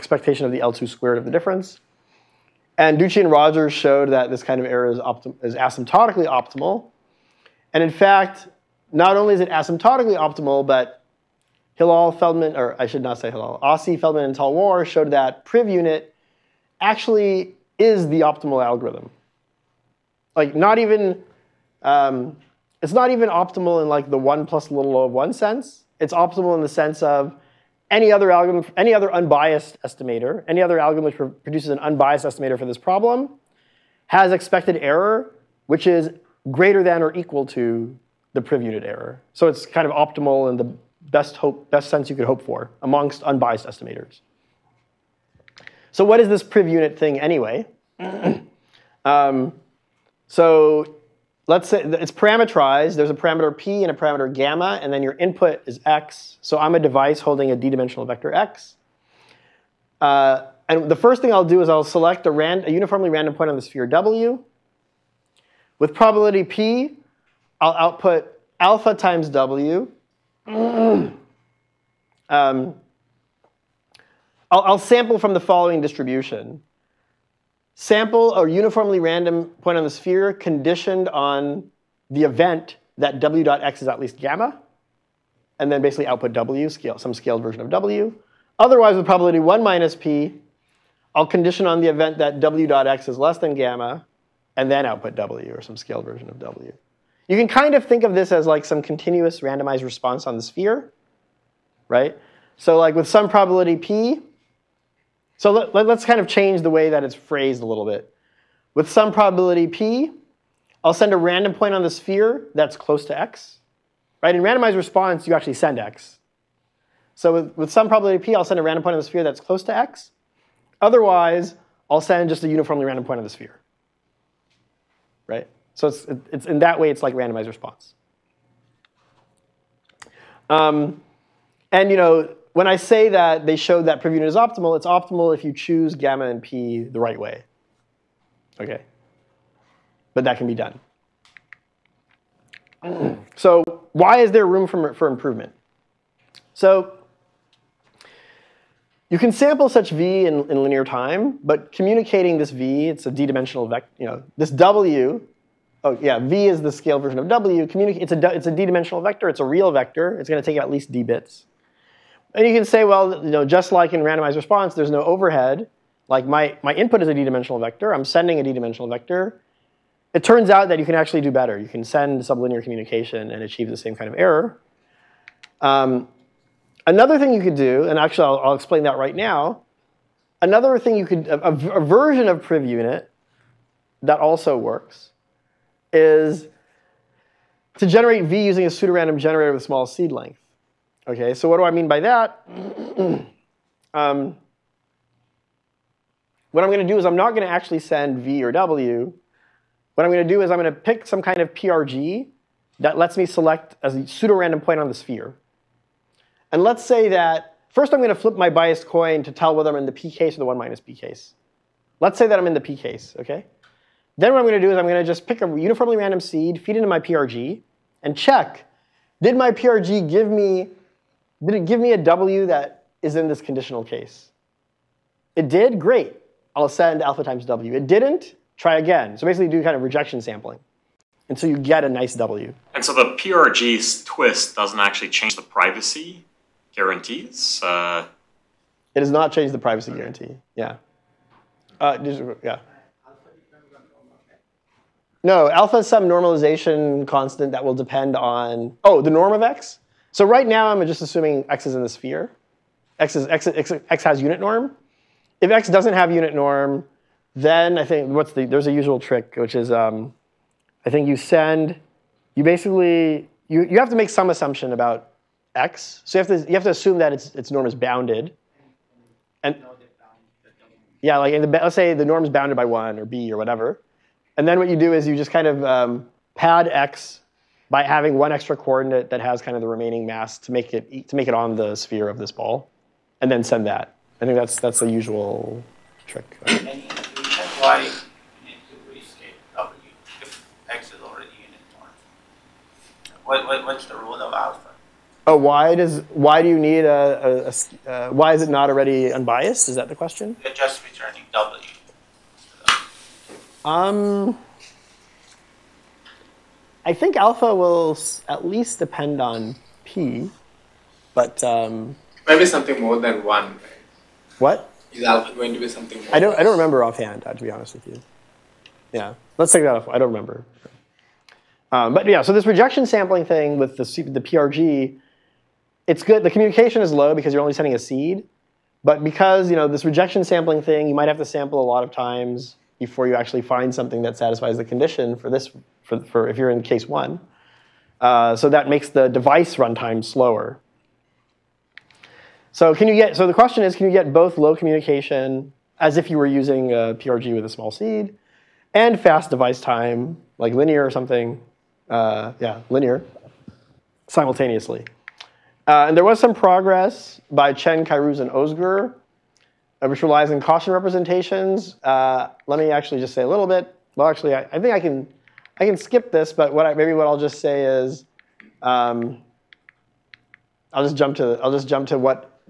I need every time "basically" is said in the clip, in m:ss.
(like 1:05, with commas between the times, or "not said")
1:25, 3:49, 4:22.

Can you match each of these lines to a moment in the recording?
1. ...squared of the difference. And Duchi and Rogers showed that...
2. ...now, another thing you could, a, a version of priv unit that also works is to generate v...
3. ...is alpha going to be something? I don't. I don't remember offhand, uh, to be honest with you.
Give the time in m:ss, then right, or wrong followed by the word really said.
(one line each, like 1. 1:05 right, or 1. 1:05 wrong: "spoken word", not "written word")
1. 0:00 right
2. 2:59 right
3. 5:14 right.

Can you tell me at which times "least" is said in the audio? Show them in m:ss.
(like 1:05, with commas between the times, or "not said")
1:23, 2:40, 5:08.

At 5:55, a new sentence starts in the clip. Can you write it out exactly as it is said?
Uh, and there was some progress by Chen, Kairouz, and Ozgur.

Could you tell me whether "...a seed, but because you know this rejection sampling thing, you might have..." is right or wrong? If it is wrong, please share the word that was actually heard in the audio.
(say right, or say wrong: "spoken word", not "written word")
right.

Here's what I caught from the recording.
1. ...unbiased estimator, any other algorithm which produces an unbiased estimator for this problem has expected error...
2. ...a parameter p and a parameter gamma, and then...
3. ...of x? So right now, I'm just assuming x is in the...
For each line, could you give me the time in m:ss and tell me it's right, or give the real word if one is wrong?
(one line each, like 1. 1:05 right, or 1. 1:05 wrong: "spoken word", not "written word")
1. 0:29 right
2. 0:53 right
3. 4:09 right.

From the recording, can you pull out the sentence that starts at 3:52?
And so the PRG's twist doesn't actually change the privacy guarantees?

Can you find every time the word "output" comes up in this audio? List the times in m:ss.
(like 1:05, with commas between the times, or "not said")
1:07, 1:26, 1:34.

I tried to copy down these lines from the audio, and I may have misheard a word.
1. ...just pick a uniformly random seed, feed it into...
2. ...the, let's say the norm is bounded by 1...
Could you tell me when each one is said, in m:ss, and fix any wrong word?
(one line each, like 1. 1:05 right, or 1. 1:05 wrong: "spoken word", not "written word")
1. 3:35 right
2. 4:31 right.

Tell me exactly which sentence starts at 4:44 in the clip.
I think that's that's the usual trick.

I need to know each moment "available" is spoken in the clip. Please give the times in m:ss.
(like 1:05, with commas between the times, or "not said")
not said.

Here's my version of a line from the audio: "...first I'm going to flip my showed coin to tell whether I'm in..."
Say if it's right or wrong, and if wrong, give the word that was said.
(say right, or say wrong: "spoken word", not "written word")
wrong: "biased", not "showed".